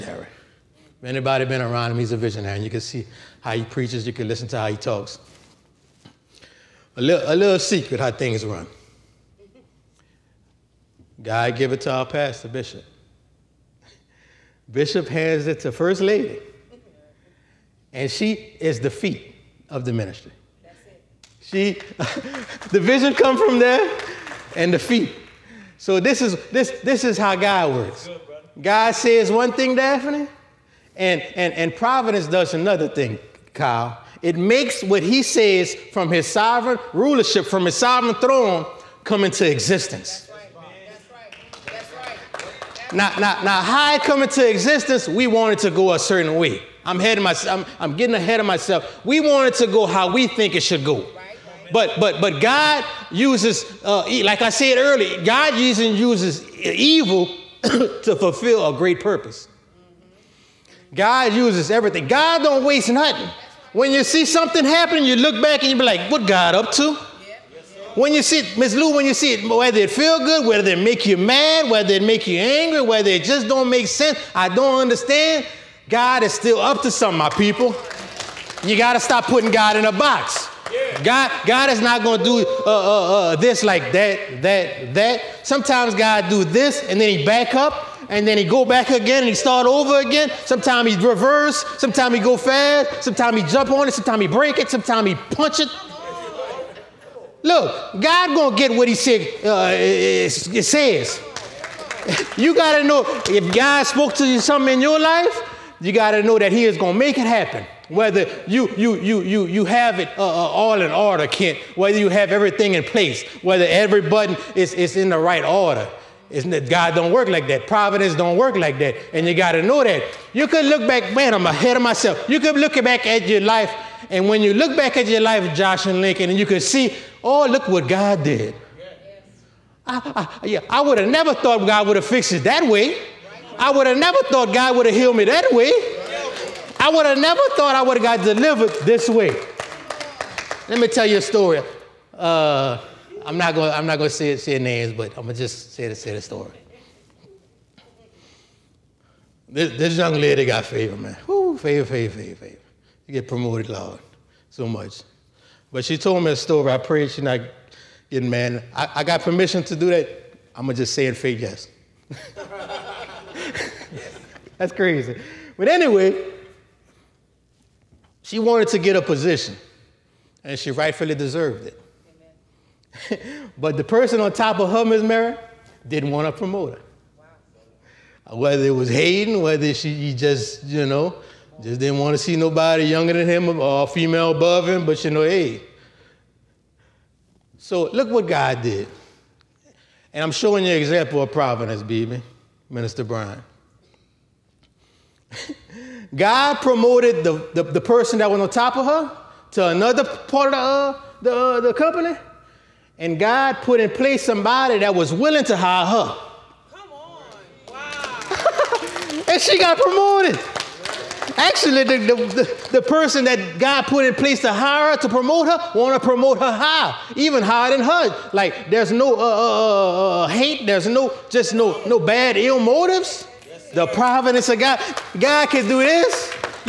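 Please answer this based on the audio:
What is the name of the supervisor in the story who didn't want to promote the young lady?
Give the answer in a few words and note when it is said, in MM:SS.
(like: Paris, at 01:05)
Ms. Mary, at 02:54.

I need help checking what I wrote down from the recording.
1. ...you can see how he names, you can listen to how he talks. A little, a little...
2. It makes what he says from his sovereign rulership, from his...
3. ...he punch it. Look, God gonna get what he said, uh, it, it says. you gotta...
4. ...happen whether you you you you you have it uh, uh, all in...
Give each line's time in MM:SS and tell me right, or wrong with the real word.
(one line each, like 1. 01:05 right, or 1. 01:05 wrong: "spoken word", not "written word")
1. 00:02 wrong: "preaches", not "names"
2. 00:34 right
3. 01:35 right
4. 01:47 right.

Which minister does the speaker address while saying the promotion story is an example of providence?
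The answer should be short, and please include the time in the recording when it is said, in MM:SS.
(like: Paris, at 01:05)
Minister Brian, at 03:12.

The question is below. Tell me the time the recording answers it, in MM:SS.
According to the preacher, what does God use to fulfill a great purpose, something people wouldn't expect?
00:56.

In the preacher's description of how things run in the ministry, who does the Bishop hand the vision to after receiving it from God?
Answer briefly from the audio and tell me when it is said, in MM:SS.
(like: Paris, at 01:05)
First Lady, at 00:15.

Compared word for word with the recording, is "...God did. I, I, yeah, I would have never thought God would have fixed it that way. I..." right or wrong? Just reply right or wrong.
right.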